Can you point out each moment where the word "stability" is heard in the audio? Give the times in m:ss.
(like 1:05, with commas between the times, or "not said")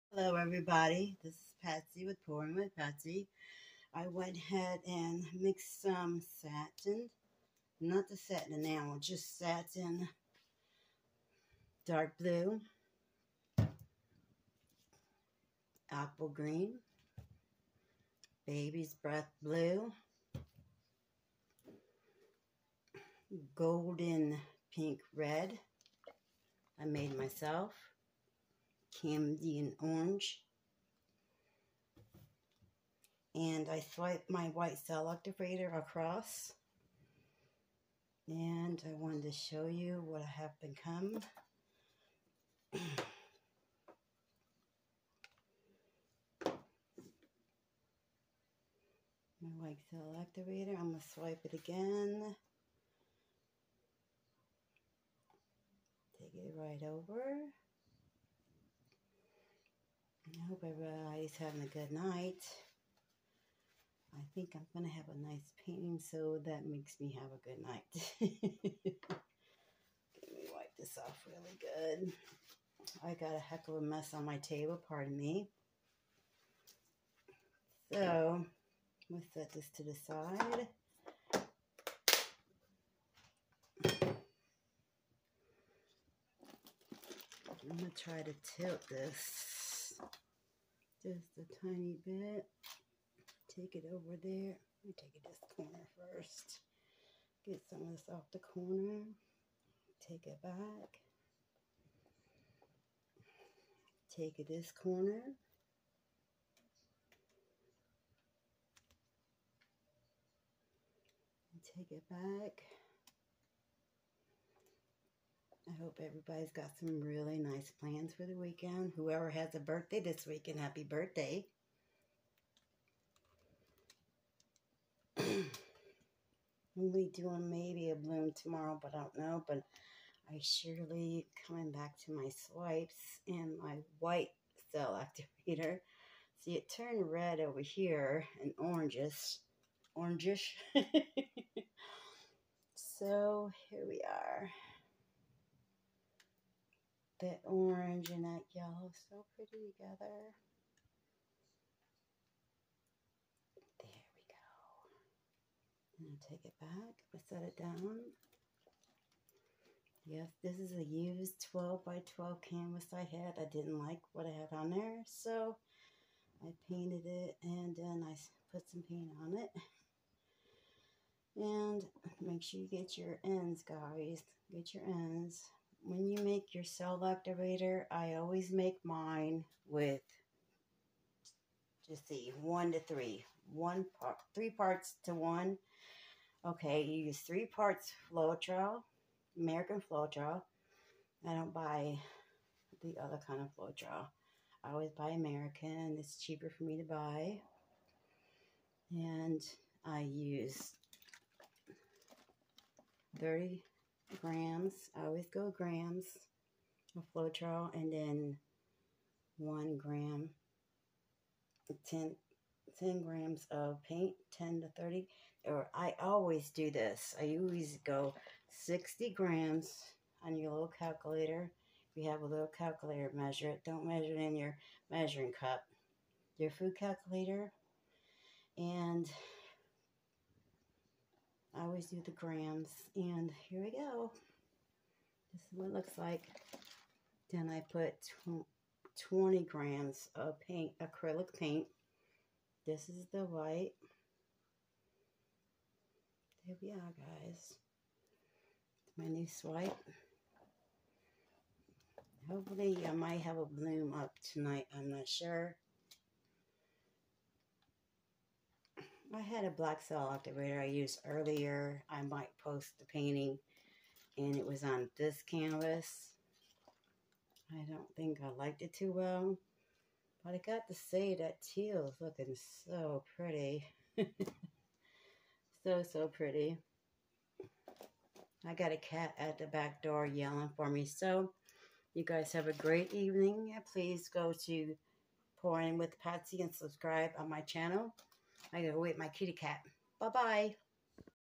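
not said.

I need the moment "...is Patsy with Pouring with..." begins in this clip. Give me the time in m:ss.
0:01.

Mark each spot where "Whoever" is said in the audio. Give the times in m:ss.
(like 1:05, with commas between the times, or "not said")
1:58.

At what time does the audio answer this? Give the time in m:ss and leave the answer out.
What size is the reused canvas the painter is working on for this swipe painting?
2:41.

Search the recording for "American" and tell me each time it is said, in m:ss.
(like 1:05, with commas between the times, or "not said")
3:09, 3:15.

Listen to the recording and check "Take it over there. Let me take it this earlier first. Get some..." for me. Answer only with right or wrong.
wrong.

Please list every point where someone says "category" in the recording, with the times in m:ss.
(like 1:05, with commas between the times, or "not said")
not said.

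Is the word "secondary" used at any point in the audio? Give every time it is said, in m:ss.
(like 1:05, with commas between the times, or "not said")
not said.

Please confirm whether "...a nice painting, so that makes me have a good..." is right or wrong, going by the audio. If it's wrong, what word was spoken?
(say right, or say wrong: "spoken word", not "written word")
right.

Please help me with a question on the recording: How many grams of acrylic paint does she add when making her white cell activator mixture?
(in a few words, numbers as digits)
20 grams.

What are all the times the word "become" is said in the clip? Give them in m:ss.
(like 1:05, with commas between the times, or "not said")
0:40.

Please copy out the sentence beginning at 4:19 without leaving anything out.
I had a black cell activator I used earlier.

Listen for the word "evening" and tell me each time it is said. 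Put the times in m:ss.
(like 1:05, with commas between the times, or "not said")
4:42.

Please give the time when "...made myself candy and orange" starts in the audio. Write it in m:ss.
0:26.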